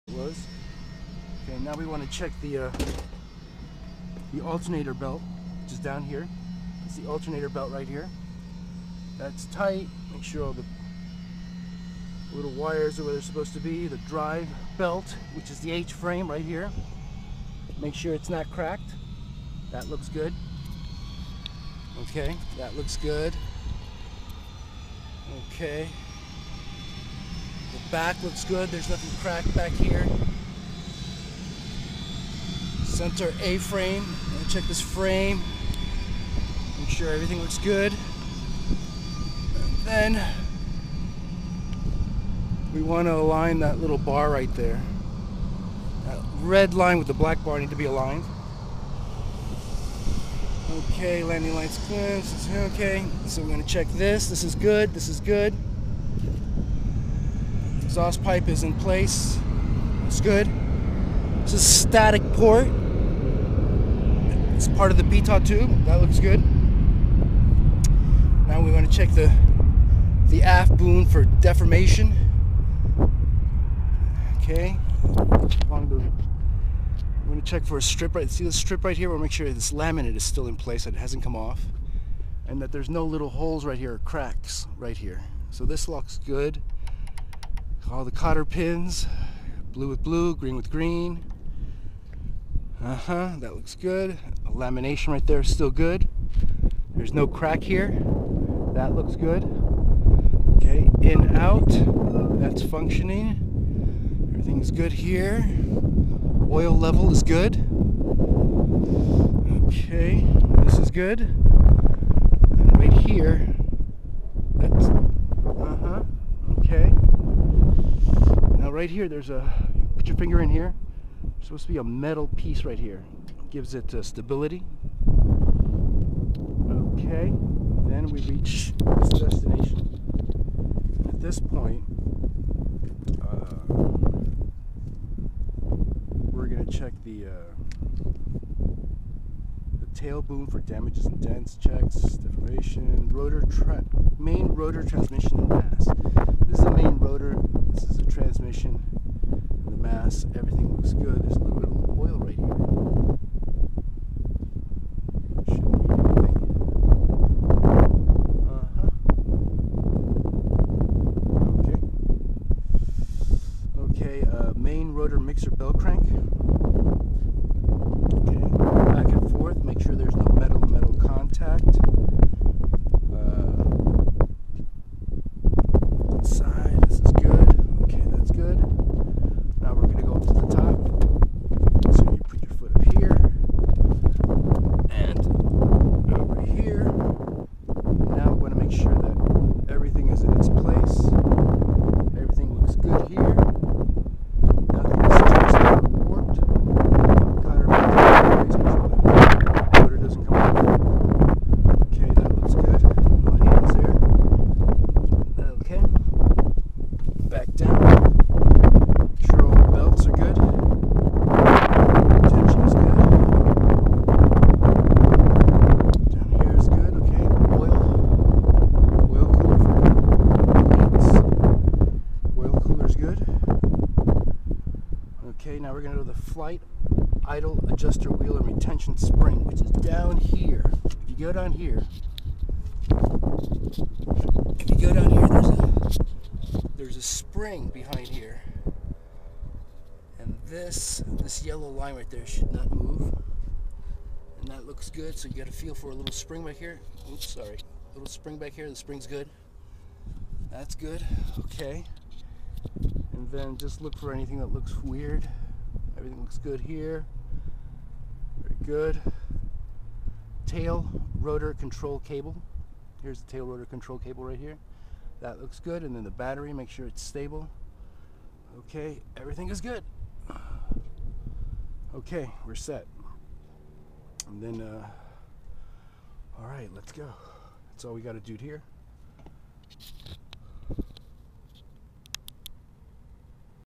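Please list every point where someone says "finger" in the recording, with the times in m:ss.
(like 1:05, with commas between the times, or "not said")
2:00.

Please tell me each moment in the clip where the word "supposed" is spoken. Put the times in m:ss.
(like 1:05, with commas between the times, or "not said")
0:13, 2:01.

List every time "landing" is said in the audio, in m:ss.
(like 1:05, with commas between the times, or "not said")
0:51.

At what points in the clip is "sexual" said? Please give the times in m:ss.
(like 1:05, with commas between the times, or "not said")
not said.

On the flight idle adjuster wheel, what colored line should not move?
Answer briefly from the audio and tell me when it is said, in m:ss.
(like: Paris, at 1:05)
Yellow line, at 4:01.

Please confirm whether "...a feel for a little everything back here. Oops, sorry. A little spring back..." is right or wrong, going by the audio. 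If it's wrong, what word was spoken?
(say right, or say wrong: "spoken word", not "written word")
wrong: "spring", not "everything".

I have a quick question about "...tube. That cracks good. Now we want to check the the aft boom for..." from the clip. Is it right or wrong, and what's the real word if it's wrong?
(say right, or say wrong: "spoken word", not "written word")
wrong: "looks", not "cracks".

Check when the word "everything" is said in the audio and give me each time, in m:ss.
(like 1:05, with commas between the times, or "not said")
0:37, 1:44, 2:30, 4:15, 4:29.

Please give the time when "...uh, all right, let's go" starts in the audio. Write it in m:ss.
4:34.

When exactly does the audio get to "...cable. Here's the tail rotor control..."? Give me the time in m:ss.
4:21.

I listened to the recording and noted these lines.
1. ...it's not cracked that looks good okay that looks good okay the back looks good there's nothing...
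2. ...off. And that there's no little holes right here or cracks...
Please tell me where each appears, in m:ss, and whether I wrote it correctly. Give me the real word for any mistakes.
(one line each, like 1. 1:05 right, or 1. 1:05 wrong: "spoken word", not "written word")
1. 0:18 right
2. 1:21 right.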